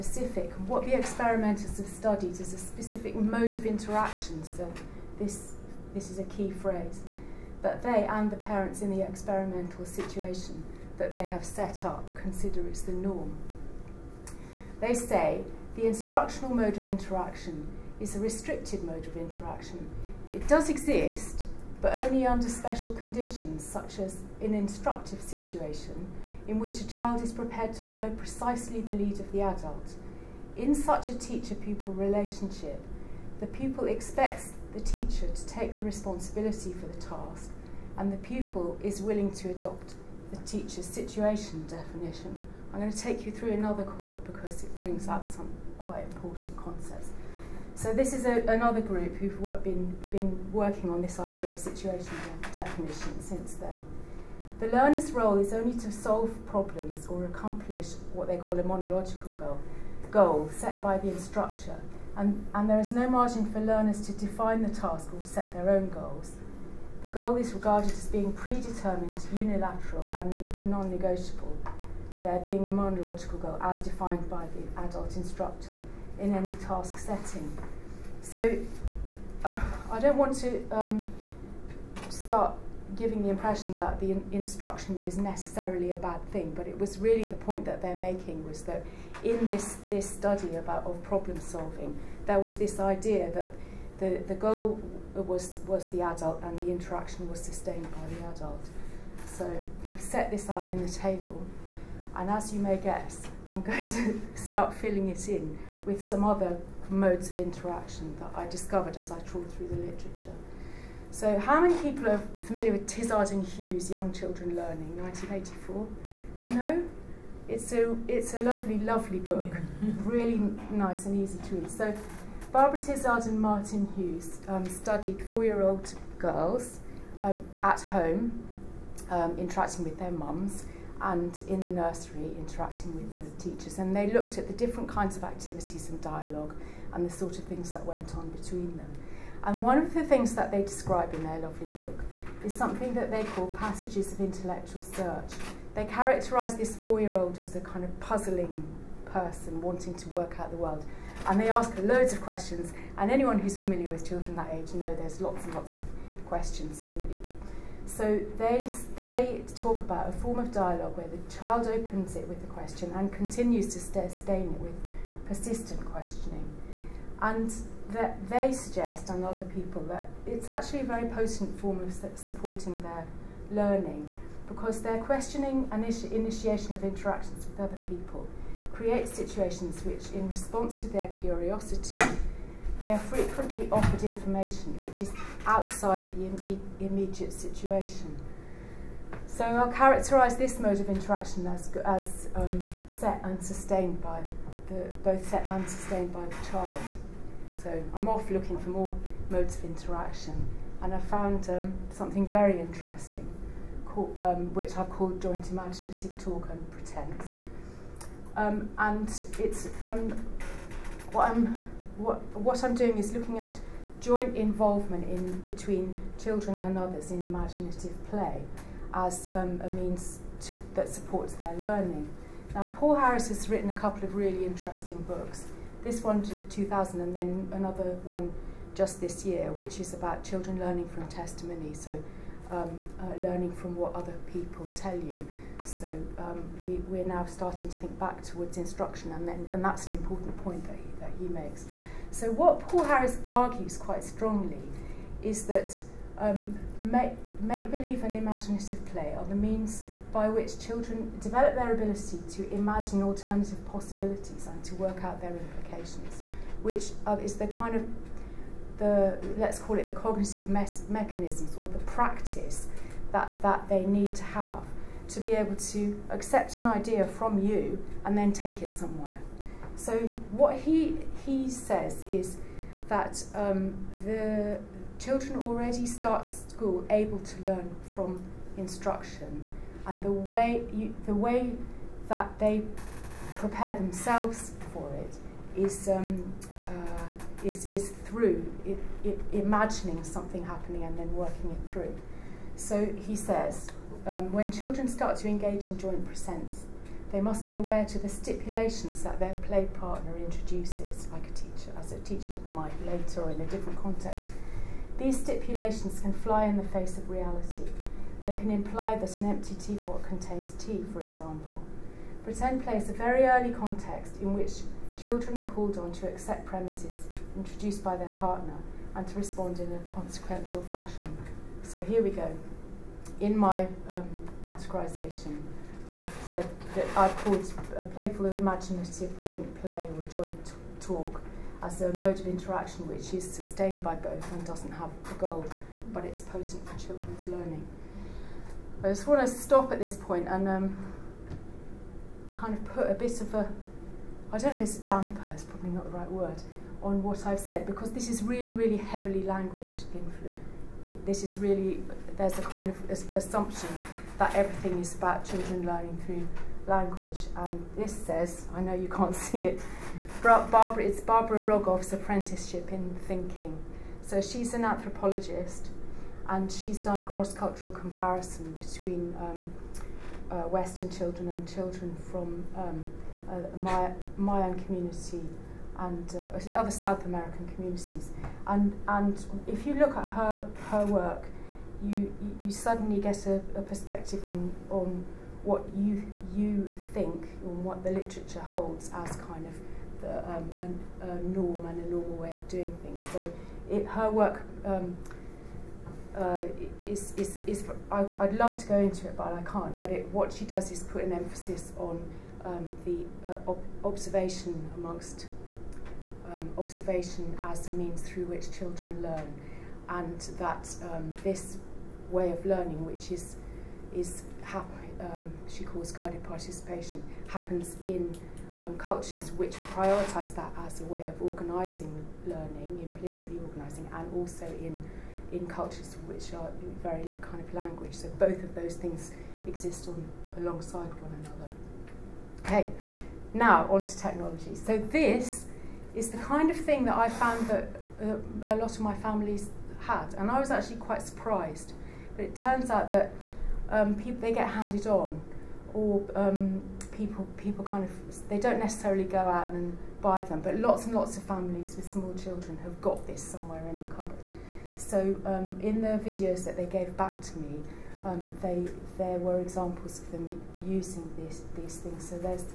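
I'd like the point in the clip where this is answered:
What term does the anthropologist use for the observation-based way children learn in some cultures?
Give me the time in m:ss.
6:55.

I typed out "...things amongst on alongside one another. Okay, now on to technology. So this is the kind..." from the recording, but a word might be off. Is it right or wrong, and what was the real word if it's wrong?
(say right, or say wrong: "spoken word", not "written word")
wrong: "exist", not "amongst".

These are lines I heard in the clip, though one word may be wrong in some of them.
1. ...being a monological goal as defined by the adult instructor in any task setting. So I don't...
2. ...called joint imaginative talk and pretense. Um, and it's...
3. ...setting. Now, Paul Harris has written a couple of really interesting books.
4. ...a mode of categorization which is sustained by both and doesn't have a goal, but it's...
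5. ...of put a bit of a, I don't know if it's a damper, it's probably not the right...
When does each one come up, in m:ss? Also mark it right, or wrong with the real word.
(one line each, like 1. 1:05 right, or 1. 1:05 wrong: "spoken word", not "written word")
1. 1:12 right
2. 3:24 right
3. 3:41 wrong: "learning", not "setting"
4. 5:31 wrong: "interaction", not "categorization"
5. 5:42 right.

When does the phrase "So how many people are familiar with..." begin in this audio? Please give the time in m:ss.
1:51.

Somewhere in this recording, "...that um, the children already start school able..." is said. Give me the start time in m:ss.
4:32.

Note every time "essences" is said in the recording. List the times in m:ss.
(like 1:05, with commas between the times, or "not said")
not said.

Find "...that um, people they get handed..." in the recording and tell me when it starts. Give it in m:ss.
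7:22.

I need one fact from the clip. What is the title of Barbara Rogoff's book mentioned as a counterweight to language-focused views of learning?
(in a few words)
Apprenticeship in Thinking.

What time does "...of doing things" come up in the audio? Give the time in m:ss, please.
6:32.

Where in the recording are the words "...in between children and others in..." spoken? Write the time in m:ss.
3:35.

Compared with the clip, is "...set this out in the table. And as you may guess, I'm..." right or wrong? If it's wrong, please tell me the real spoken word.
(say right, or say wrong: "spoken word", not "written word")
right.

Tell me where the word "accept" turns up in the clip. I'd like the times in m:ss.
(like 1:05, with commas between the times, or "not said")
4:26, 5:16.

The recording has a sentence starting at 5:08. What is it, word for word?
They can imply that an empty teapot contains tea, for example.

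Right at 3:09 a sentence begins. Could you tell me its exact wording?
So I'll characterise this mode of interaction as, as um, set and sustained by the, both set and sustained by the child.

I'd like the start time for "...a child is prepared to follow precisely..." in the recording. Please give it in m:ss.
0:26.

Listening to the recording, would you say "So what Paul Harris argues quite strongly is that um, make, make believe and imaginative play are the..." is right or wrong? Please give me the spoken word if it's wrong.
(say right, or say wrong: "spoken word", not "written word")
right.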